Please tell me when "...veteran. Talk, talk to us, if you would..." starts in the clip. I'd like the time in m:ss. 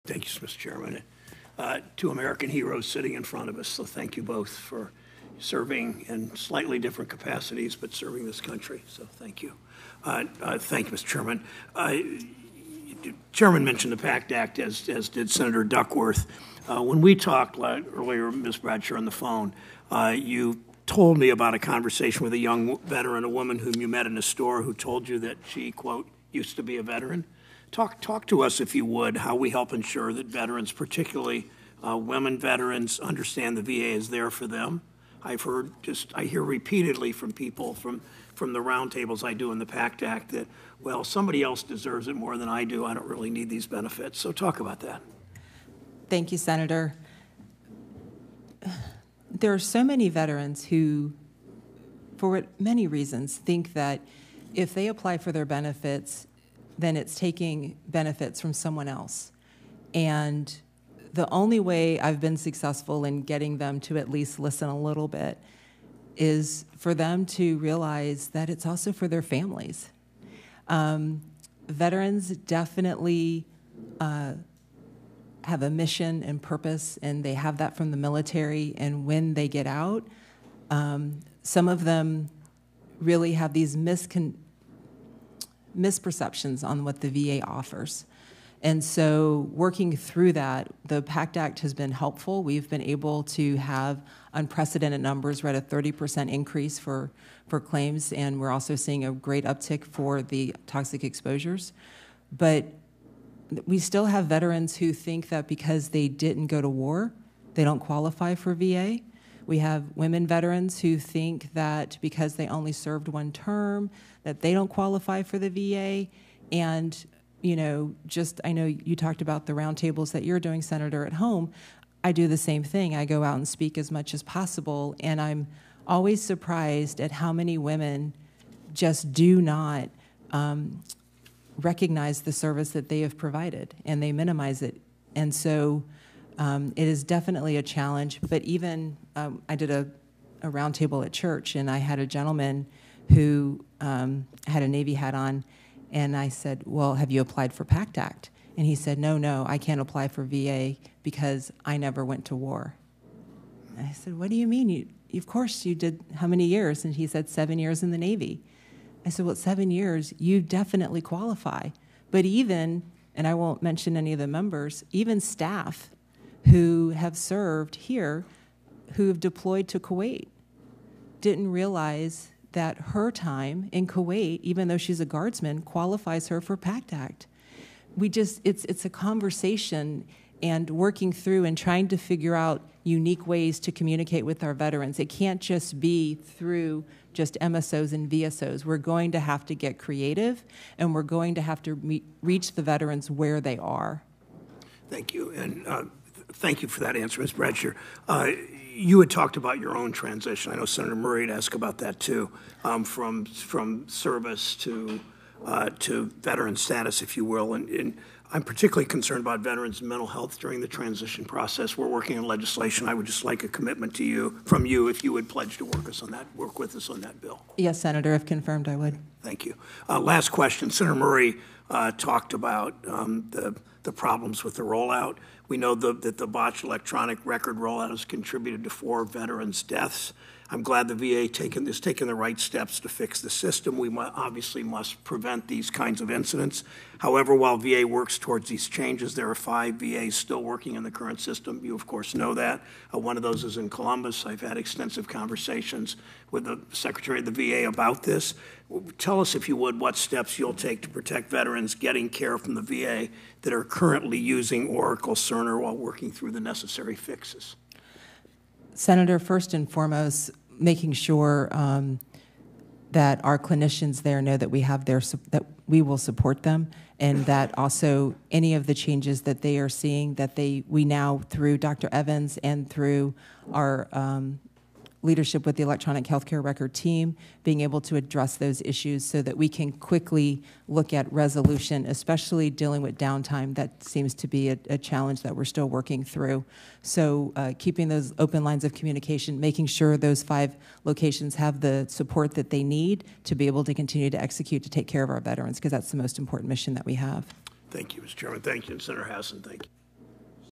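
0:26.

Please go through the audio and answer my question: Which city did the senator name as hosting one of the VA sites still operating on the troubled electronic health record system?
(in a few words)
Columbus.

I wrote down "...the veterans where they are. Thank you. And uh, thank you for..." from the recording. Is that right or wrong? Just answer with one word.
right.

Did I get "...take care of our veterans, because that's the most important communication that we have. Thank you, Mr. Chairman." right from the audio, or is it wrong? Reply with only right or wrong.
wrong.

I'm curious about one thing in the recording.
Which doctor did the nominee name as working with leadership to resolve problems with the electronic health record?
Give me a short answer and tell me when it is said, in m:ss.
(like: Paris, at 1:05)
Dr. Evans, at 4:31.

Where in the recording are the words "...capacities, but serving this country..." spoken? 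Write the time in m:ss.
0:07.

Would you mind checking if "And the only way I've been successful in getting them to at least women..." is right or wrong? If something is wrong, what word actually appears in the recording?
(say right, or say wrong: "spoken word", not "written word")
wrong: "listen", not "women".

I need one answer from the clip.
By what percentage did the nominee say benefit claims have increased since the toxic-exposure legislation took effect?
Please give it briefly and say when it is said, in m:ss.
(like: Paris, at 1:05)
30%, at 1:35.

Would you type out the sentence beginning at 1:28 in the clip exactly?
And so, working through that, the PACT Act has been helpful.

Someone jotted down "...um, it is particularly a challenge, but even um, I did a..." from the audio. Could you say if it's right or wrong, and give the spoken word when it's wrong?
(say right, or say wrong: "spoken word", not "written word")
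wrong: "definitely", not "particularly".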